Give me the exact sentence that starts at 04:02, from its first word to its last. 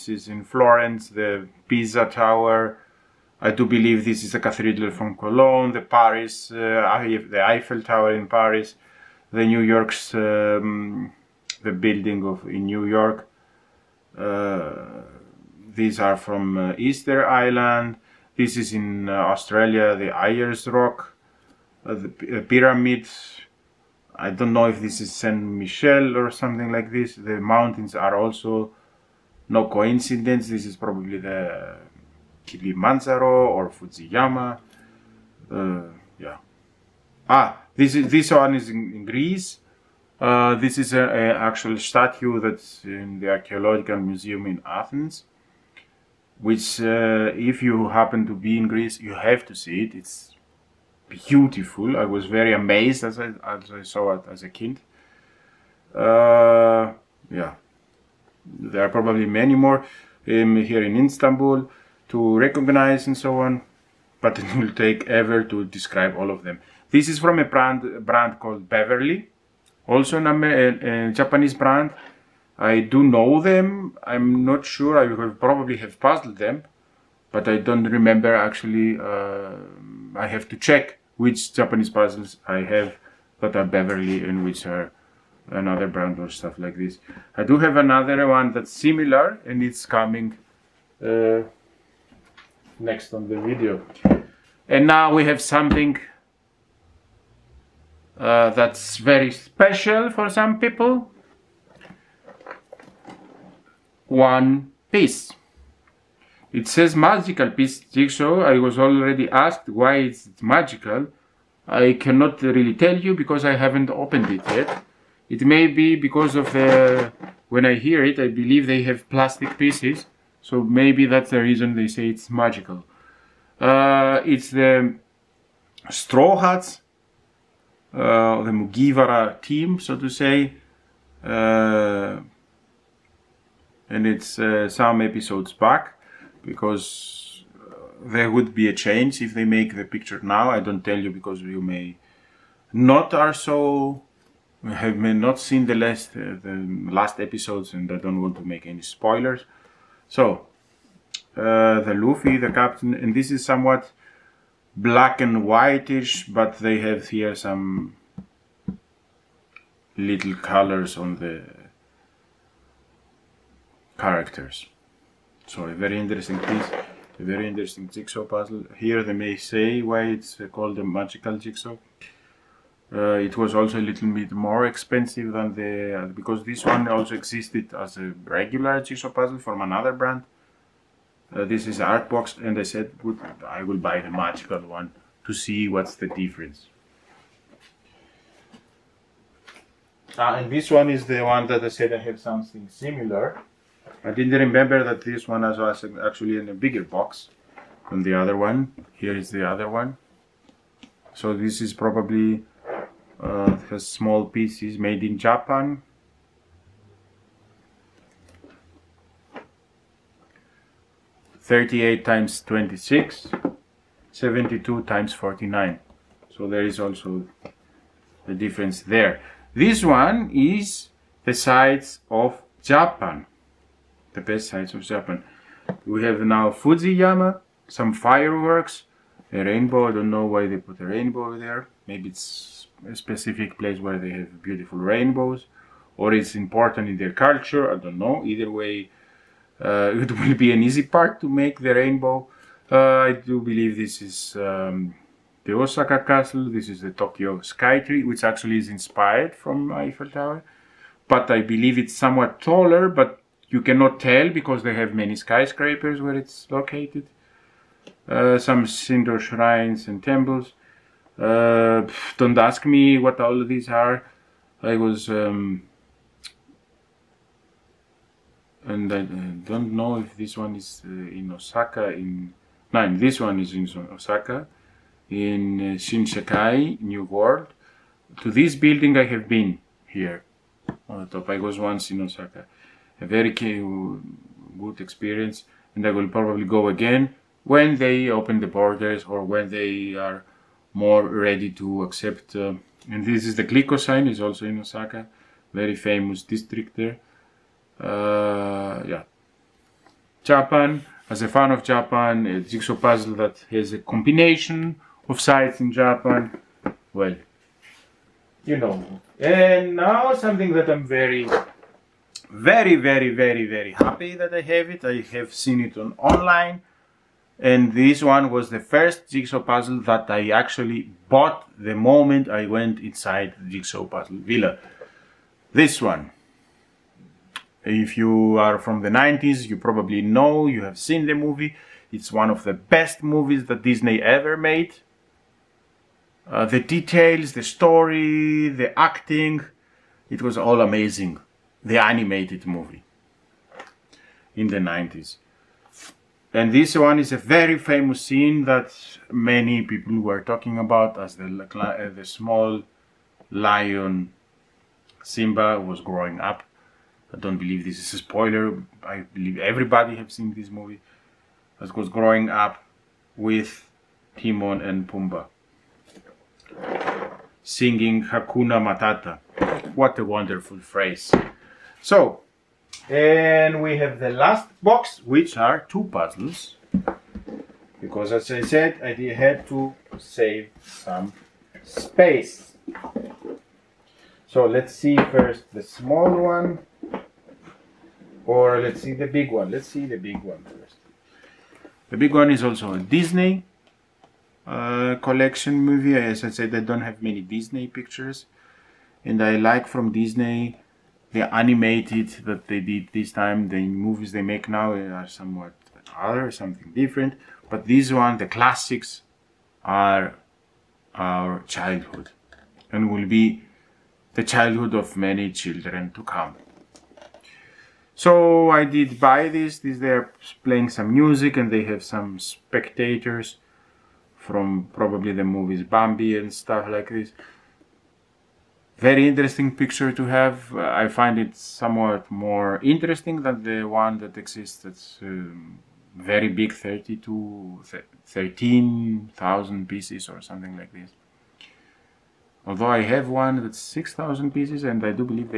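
Uh, I do believe this is um, the Osaka Castle.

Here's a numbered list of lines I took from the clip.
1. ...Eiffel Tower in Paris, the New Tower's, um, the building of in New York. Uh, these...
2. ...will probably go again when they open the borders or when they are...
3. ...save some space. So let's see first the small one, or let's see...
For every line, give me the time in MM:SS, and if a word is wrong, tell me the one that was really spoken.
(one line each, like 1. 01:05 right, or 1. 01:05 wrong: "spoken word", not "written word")
1. 00:07 wrong: "York", not "Tower"
2. 04:45 right
3. 06:19 right.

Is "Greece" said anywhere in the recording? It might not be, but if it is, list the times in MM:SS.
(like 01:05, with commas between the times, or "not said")
00:39, 00:48.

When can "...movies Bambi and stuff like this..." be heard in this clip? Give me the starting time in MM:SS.
07:05.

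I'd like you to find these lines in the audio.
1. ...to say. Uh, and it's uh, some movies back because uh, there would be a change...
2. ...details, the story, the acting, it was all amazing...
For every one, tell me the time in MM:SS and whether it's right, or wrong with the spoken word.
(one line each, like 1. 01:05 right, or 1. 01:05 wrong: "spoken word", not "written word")
1. 02:09 wrong: "episodes", not "movies"
2. 05:36 right.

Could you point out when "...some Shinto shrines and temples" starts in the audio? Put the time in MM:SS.
04:18.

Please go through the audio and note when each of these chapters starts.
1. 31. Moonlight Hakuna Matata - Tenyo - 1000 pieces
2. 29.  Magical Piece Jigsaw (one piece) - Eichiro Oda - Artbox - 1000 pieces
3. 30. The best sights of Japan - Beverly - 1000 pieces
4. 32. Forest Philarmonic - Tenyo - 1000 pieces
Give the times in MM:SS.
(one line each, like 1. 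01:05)
1. 05:26
2. 01:37
3. 03:17
4. 06:30.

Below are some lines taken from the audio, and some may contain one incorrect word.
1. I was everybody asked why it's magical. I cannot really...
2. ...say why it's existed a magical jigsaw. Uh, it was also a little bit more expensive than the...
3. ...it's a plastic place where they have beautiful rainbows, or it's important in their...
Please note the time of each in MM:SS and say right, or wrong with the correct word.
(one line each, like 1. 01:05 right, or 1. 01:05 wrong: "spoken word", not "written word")
1. 01:48 wrong: "already", not "everybody"
2. 02:49 wrong: "called", not "existed"
3. 03:52 wrong: "specific", not "plastic".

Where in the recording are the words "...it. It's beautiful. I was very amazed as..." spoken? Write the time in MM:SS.
00:49.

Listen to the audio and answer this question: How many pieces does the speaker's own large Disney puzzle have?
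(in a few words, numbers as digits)
6,000.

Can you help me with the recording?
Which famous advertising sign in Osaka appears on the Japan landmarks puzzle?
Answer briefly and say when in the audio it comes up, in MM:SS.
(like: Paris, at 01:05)
Glico sign, at 04:53.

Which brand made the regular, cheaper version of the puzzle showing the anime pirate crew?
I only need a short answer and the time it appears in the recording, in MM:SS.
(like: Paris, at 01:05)
Artbox, at 03:01.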